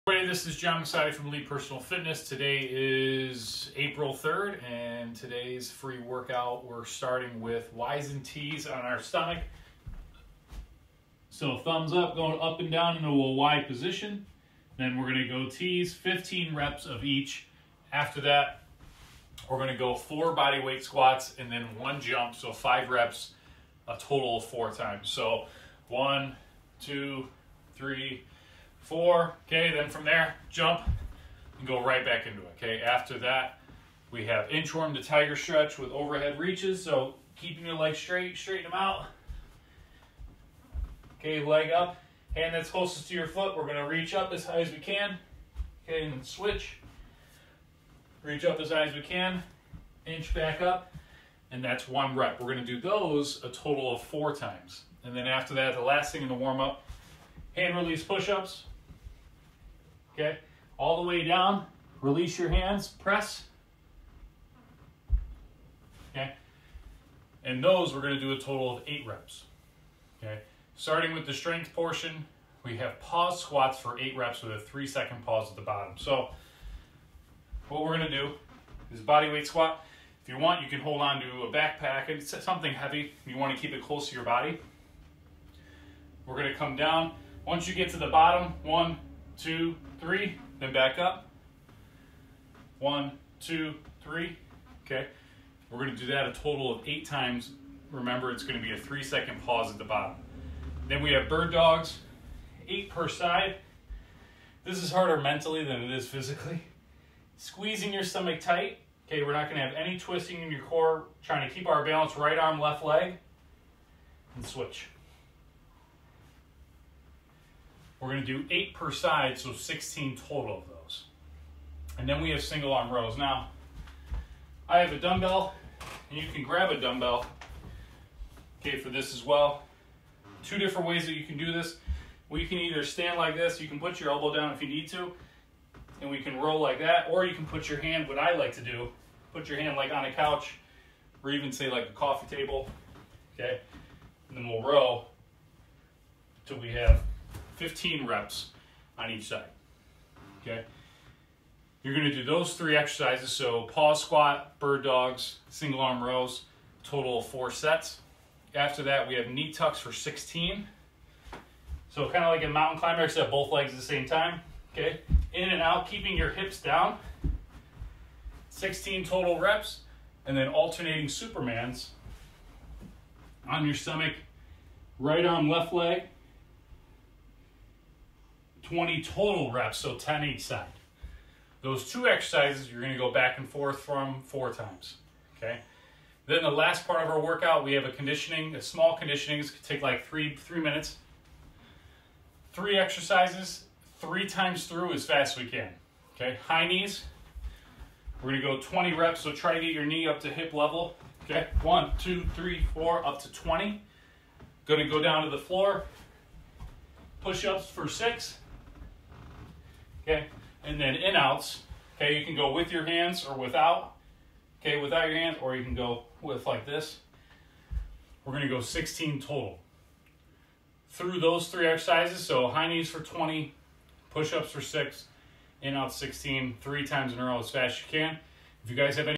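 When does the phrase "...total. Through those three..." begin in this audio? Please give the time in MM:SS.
03:39.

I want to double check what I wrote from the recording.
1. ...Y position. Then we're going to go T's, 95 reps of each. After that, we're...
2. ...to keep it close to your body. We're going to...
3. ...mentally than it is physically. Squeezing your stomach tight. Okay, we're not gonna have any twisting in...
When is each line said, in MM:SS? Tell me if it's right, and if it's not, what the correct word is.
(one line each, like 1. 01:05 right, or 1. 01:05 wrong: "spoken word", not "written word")
1. 00:13 wrong: "15", not "95"
2. 01:23 right
3. 01:45 right.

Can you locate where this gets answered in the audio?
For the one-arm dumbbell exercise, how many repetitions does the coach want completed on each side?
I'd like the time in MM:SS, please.
02:27.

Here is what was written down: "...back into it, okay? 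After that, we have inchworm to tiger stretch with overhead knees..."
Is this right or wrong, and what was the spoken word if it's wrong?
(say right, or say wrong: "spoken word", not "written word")
wrong: "reaches", not "knees".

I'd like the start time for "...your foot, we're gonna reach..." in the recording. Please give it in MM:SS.
00:43.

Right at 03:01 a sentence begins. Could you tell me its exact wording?
Those two exercises you're gonna go back and forth from four times, okay?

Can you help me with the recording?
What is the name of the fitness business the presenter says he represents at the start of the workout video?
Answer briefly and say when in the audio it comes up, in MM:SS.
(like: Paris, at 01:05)
Elite Personal Fitness, at 00:01.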